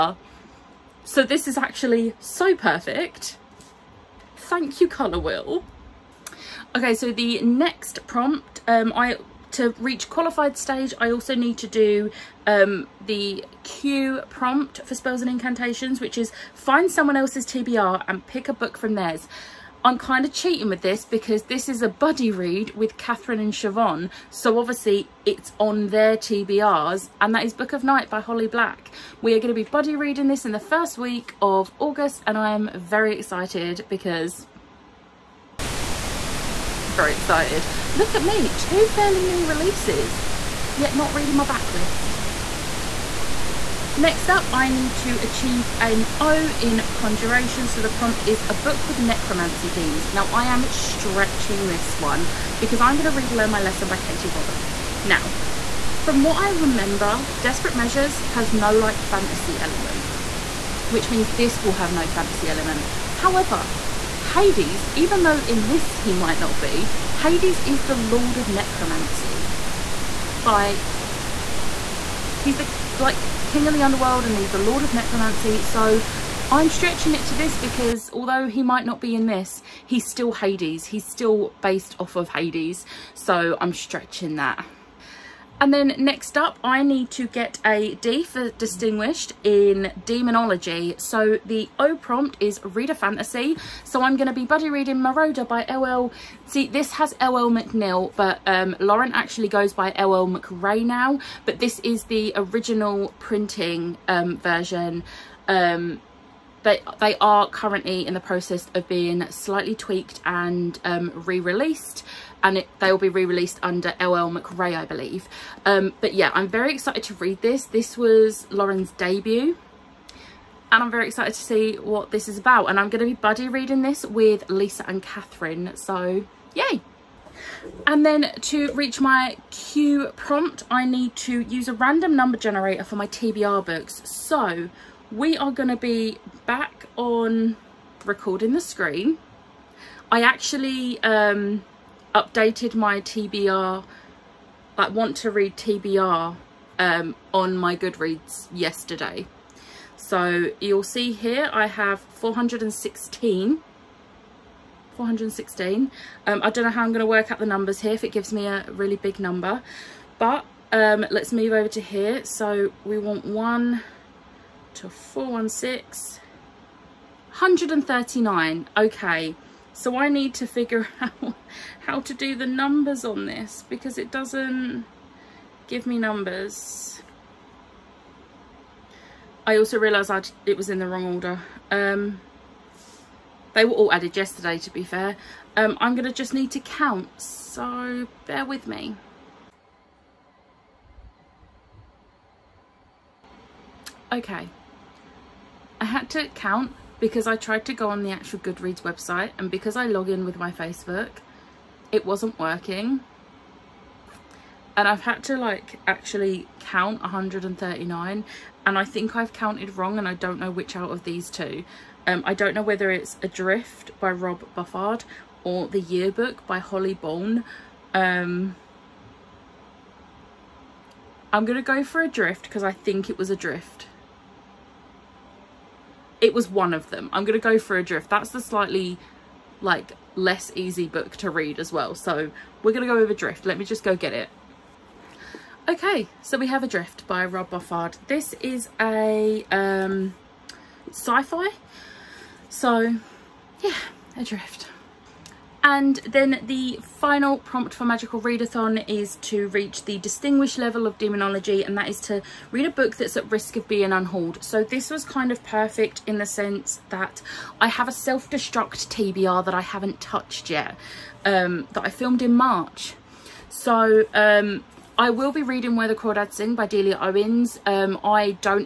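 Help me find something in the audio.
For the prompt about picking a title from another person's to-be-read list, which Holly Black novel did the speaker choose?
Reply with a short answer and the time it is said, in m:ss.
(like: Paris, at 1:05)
Book of Night, at 0:27.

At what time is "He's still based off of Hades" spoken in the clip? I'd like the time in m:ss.
1:20.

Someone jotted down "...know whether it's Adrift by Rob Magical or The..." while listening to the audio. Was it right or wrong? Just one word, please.
wrong.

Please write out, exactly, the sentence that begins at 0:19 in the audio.
I'm kind of cheating with this because this is a buddy read with Catherine and Siobhan.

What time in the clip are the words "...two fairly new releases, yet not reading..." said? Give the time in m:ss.
0:38.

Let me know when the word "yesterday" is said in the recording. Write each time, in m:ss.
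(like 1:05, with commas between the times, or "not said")
2:28, 3:04.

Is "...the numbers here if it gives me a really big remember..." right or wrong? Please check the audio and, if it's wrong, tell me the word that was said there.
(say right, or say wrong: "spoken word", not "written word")
wrong: "number", not "remember".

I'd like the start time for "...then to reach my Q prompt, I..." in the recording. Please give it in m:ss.
2:08.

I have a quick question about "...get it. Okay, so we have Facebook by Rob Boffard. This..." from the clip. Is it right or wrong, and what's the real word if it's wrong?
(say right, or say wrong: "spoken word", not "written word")
wrong: "Adrift", not "Facebook".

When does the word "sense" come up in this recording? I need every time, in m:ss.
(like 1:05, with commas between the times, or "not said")
4:16.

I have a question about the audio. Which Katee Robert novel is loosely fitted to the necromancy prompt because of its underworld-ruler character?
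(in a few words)
Learn My Lesson.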